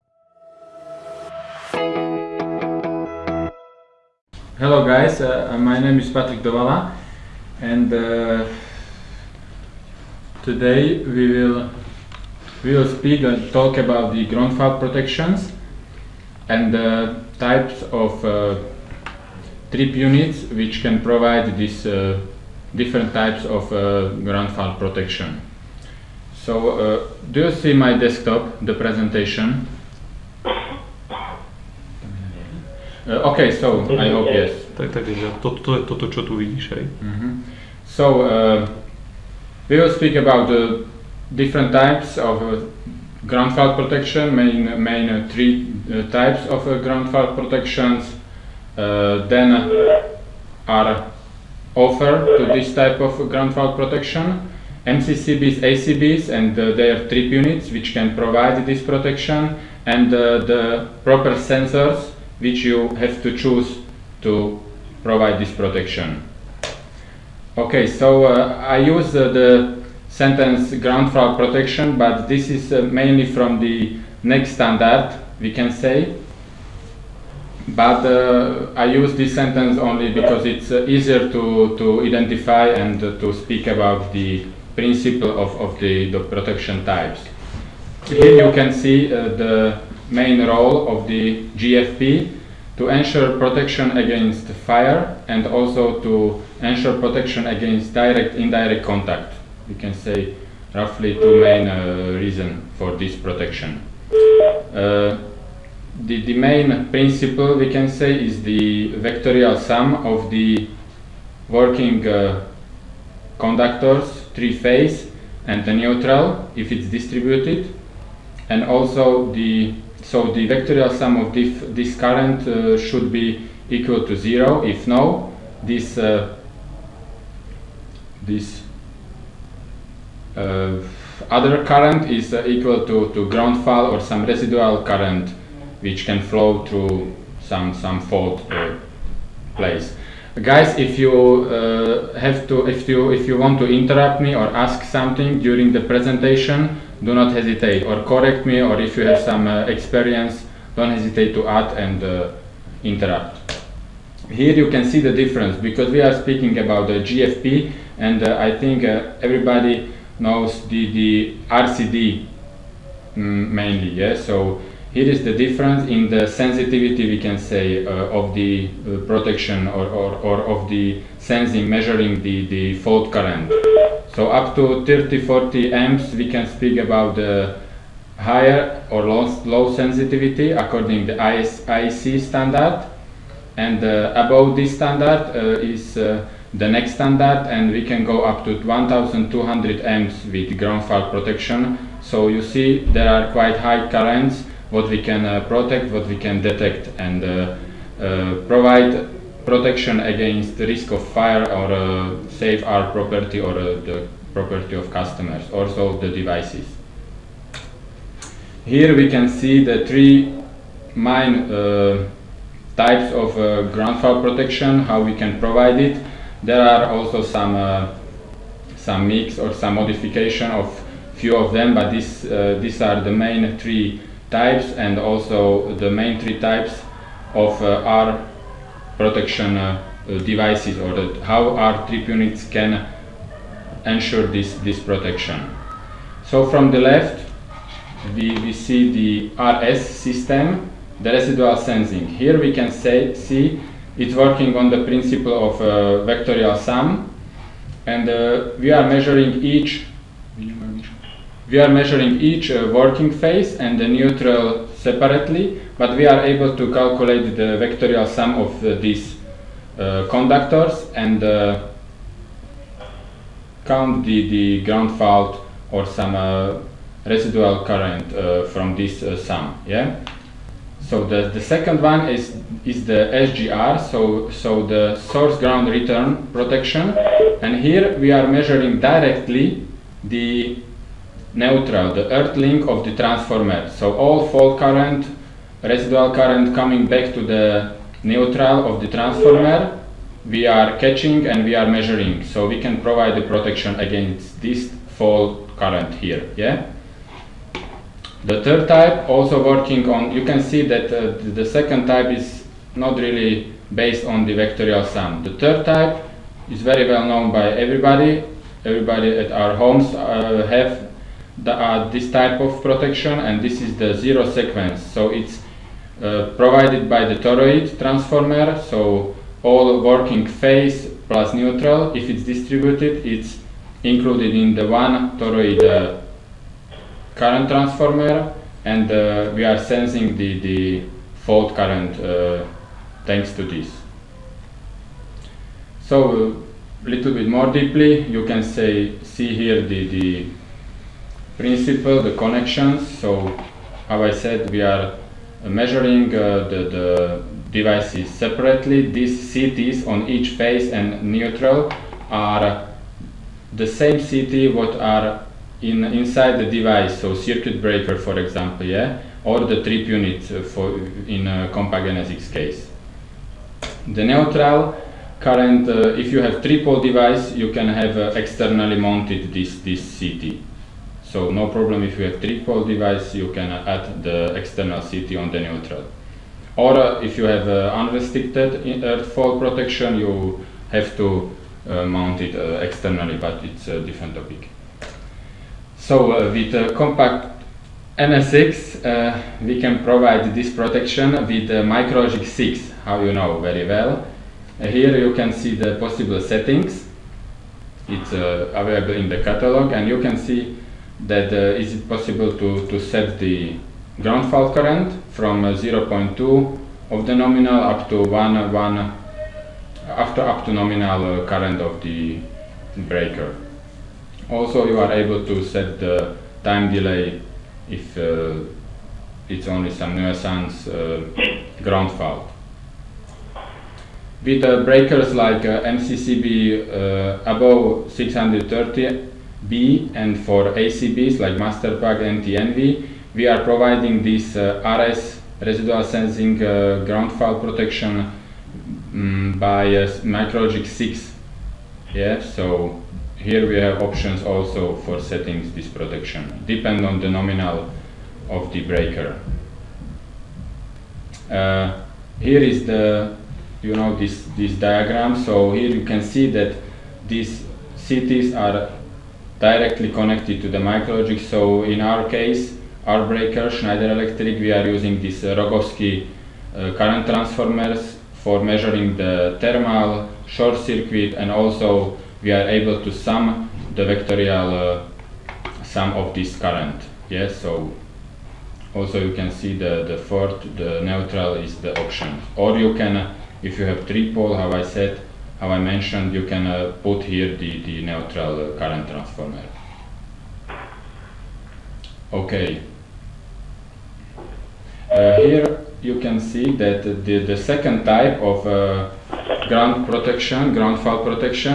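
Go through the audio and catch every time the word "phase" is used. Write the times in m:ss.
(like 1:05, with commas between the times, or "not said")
1:54, 4:13, 5:20, 5:50.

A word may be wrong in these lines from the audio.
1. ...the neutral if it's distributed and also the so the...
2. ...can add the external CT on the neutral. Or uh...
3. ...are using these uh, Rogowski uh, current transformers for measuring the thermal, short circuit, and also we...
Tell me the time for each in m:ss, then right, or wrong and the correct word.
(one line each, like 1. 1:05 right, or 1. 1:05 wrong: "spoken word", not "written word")
1. 1:55 right
2. 6:13 right
3. 7:44 right.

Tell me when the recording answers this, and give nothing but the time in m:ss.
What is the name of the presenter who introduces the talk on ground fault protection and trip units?
0:06.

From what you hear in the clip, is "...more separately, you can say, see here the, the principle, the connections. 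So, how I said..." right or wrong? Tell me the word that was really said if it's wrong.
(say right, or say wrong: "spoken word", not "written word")
wrong: "deeply", not "separately".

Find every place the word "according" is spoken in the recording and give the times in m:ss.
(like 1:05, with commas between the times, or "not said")
3:00.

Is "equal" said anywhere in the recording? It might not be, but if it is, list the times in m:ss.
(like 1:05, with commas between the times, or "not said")
2:03, 2:12.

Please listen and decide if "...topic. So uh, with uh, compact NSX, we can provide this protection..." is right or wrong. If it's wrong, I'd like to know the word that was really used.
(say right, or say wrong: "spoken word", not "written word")
right.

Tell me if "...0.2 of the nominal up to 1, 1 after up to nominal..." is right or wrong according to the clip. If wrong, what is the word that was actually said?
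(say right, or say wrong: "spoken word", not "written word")
right.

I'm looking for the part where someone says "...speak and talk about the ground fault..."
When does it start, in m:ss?
0:12.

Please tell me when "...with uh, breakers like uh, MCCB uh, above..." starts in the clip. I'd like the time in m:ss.
7:04.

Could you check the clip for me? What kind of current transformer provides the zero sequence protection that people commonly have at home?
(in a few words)
toroid transformer.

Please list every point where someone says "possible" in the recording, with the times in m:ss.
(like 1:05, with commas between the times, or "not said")
6:35, 6:41.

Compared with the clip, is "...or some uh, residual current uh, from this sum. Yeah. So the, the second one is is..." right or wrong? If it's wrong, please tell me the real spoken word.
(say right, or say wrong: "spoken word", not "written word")
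right.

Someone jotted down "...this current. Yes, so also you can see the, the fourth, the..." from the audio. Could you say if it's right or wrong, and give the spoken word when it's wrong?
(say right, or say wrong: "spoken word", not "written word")
right.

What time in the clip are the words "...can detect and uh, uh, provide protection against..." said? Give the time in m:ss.
3:16.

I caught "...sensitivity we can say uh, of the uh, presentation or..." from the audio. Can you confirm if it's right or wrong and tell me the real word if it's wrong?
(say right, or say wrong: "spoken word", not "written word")
wrong: "protection", not "presentation".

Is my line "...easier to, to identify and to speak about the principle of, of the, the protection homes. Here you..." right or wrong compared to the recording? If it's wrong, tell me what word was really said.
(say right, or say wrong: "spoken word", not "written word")
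wrong: "types", not "homes".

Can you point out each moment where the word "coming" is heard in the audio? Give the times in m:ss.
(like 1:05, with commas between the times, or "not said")
4:46.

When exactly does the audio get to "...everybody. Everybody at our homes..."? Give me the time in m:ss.
5:07.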